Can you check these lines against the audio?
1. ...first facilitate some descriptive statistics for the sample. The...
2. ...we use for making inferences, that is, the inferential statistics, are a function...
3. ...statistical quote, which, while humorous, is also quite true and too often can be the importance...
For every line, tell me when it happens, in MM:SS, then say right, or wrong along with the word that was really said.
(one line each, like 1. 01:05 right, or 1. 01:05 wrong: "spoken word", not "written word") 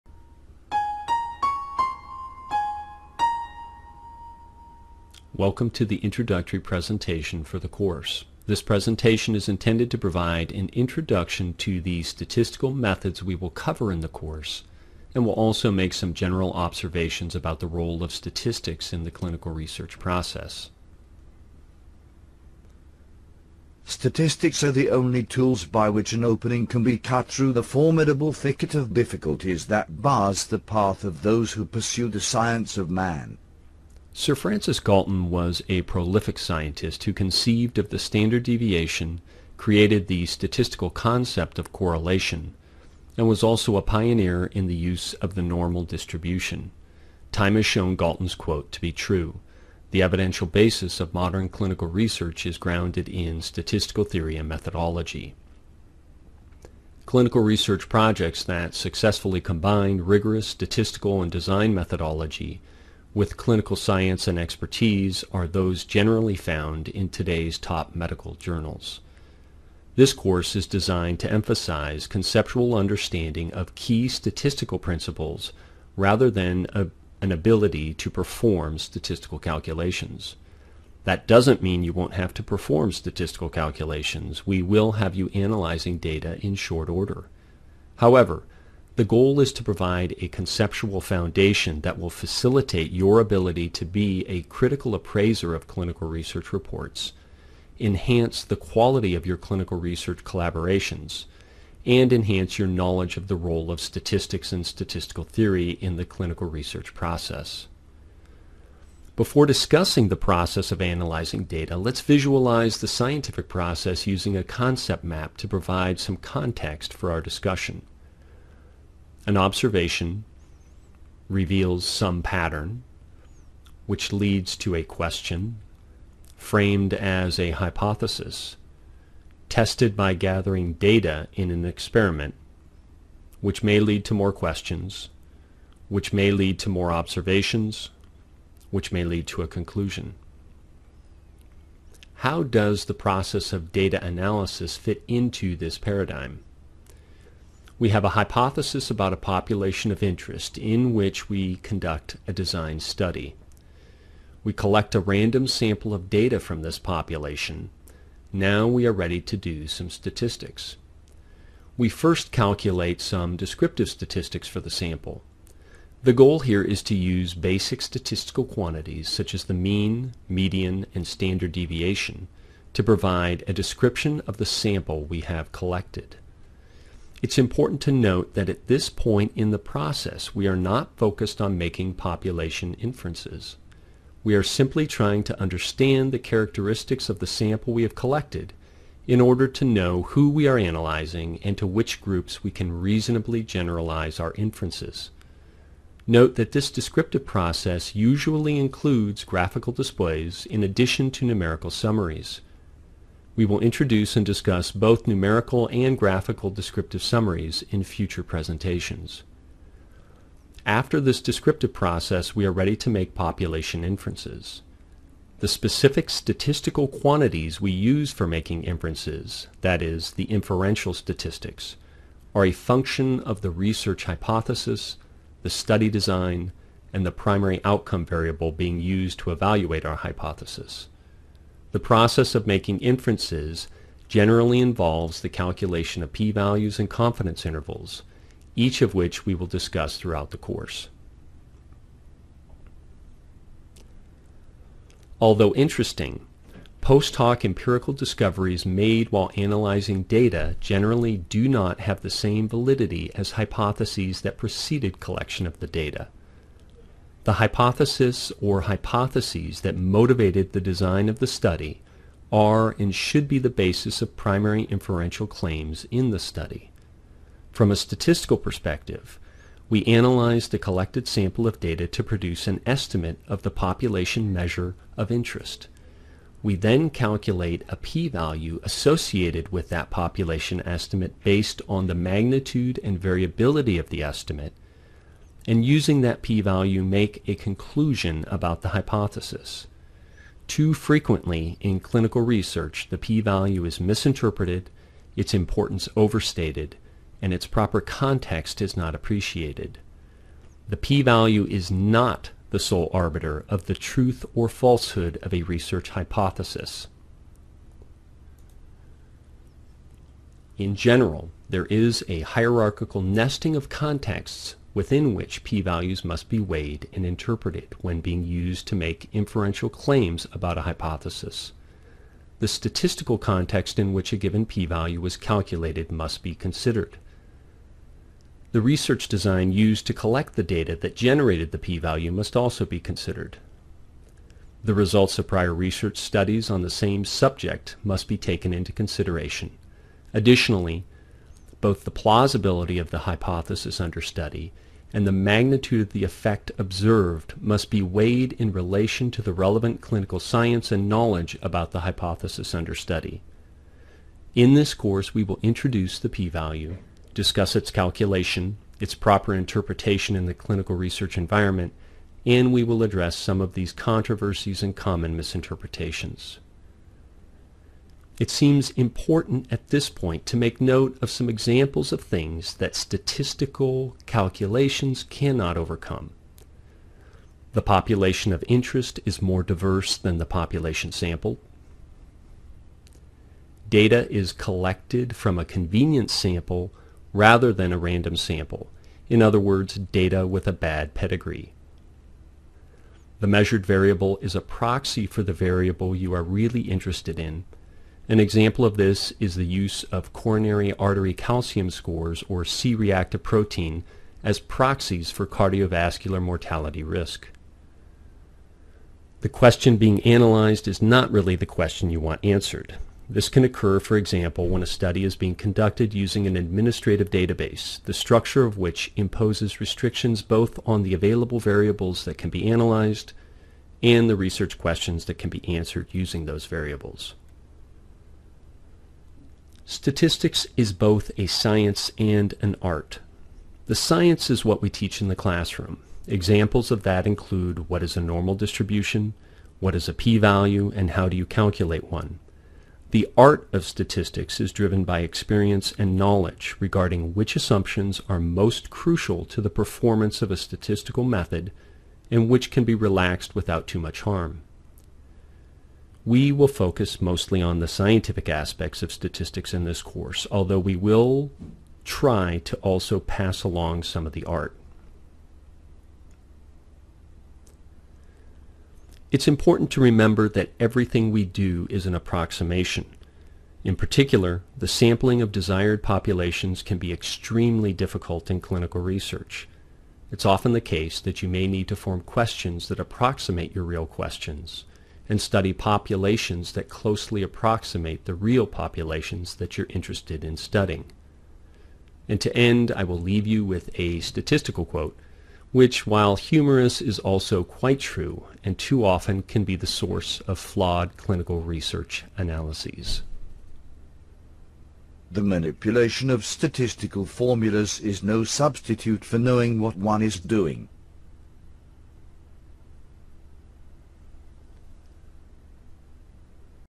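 1. 02:41 wrong: "calculate", not "facilitate"
2. 03:37 right
3. 08:13 wrong: "source", not "importance".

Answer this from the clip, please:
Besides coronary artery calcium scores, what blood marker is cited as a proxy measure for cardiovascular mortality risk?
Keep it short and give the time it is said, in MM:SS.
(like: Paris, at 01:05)
C-reactive protein, at 06:42.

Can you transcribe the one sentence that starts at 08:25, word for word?
The manipulation of statistical formulas is no substitute for knowing what one is doing.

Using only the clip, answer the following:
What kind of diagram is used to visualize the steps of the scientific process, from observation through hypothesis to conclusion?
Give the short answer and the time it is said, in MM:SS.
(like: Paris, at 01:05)
concept map, at 01:54.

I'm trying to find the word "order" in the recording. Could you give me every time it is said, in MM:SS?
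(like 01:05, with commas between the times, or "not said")
01:26, 03:09.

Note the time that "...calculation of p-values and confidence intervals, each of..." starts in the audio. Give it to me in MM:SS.
03:55.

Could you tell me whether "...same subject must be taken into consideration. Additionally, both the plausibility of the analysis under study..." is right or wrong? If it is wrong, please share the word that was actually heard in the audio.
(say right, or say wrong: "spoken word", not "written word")
wrong: "hypothesis", not "analysis".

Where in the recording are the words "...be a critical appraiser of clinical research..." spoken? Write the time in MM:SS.
01:33.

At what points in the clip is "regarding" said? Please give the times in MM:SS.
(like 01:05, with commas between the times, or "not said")
07:26.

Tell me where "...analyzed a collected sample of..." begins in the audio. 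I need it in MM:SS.
04:29.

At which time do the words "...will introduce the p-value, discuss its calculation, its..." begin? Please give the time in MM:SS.
05:55.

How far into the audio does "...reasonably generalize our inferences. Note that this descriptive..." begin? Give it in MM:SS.
03:12.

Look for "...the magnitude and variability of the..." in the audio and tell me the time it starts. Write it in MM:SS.
04:41.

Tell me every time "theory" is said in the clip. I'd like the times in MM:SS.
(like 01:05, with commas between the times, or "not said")
00:54, 01:45.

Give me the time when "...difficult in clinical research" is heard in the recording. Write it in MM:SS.
07:57.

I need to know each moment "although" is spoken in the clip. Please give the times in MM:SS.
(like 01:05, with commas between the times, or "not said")
04:05, 07:40.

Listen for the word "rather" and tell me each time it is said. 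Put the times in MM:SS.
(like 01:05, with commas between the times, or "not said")
01:15, 06:27.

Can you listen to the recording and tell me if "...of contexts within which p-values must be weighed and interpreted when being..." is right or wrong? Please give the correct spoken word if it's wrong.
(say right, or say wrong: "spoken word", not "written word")
right.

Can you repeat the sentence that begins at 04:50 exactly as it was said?
Too frequently in clinical research, the p-value is misinterpreted, its importance overstated, and its proper context is not appreciated.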